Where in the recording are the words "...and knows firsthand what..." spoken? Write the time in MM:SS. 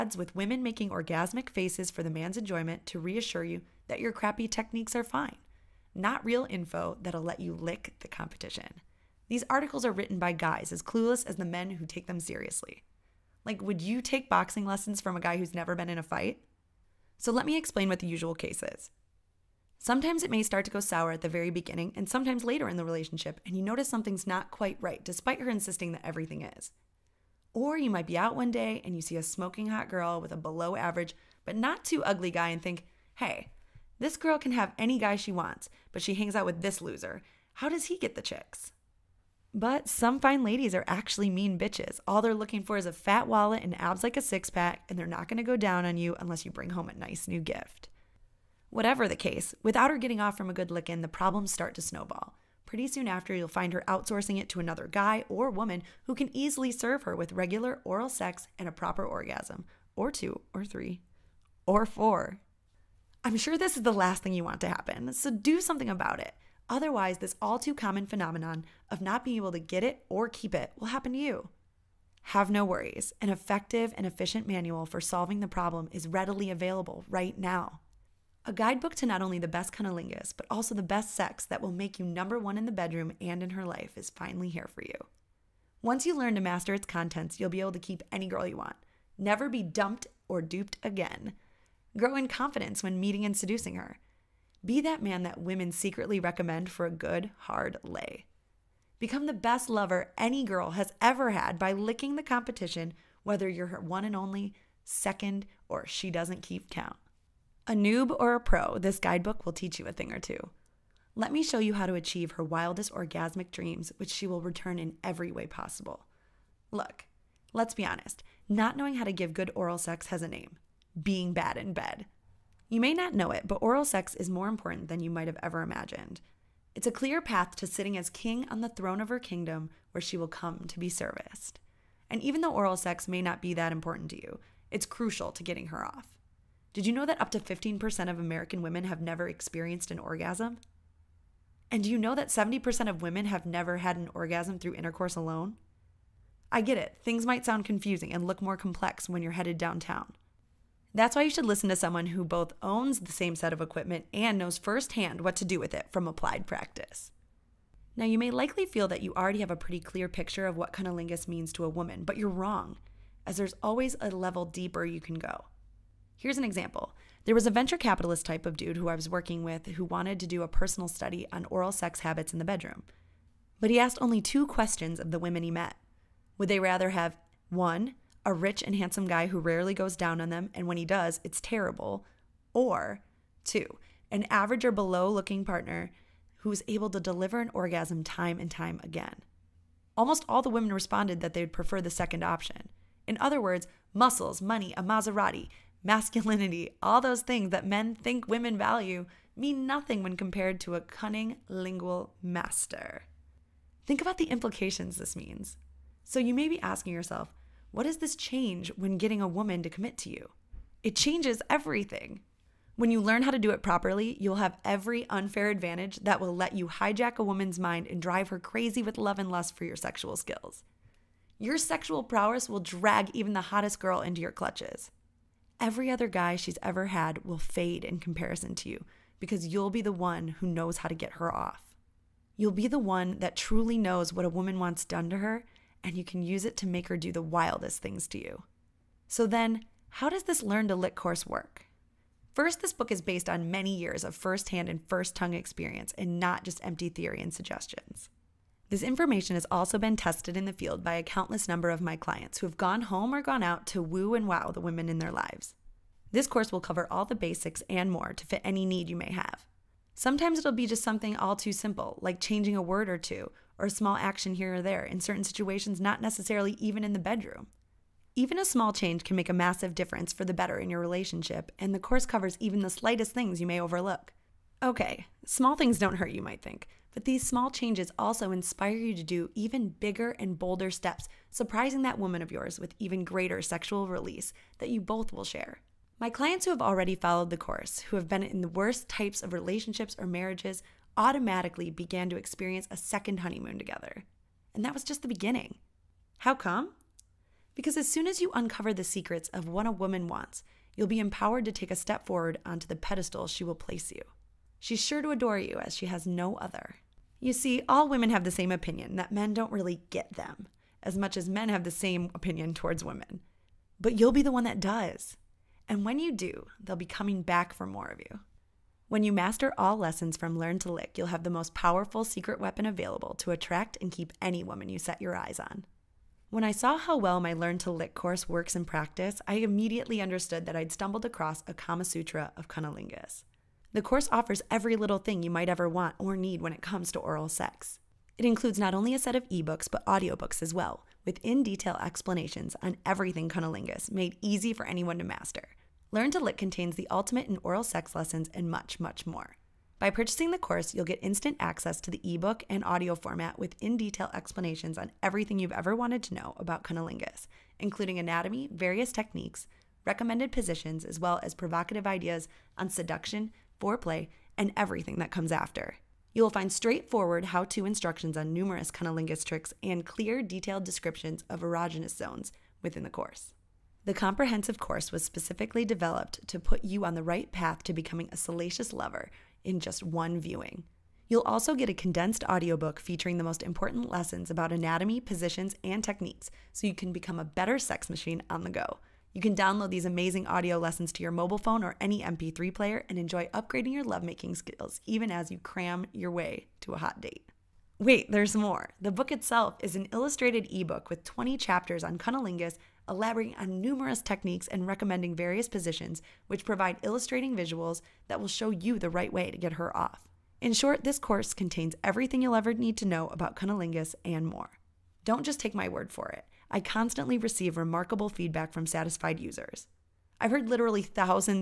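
02:34.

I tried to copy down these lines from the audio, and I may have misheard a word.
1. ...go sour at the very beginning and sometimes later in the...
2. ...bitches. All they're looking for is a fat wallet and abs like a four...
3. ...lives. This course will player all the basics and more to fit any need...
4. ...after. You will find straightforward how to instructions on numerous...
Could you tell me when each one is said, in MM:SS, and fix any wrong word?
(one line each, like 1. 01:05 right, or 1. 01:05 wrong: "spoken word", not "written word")
1. 00:20 right
2. 00:41 wrong: "six", not "four"
3. 04:15 wrong: "cover", not "player"
4. 06:05 right.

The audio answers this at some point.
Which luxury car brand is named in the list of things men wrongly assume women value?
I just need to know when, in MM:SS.
03:14.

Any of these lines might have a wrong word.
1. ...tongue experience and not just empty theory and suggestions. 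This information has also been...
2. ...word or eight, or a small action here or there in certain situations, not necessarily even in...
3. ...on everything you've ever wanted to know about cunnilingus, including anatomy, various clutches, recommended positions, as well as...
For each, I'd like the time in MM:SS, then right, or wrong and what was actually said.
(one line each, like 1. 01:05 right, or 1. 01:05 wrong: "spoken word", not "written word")
1. 04:05 right
2. 04:22 wrong: "two", not "eight"
3. 05:54 wrong: "techniques", not "clutches".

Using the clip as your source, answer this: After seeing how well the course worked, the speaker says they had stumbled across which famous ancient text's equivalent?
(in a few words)
Kama Sutra.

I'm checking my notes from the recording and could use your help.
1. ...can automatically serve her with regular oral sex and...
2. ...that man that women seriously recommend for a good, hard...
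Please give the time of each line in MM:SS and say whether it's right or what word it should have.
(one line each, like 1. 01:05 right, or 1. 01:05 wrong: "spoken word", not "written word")
1. 00:56 wrong: "easily", not "automatically"
2. 01:34 wrong: "secretly", not "seriously".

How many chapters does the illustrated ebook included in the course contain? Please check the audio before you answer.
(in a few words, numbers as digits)
20.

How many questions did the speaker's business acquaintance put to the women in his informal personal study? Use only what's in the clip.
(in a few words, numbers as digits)
2.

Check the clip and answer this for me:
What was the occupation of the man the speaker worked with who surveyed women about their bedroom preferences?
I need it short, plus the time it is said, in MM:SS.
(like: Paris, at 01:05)
Venture capitalist, at 02:47.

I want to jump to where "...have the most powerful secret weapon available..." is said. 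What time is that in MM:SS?
05:21.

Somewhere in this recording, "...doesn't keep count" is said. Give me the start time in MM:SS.
01:46.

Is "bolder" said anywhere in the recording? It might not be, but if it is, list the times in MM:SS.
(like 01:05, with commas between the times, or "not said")
04:40.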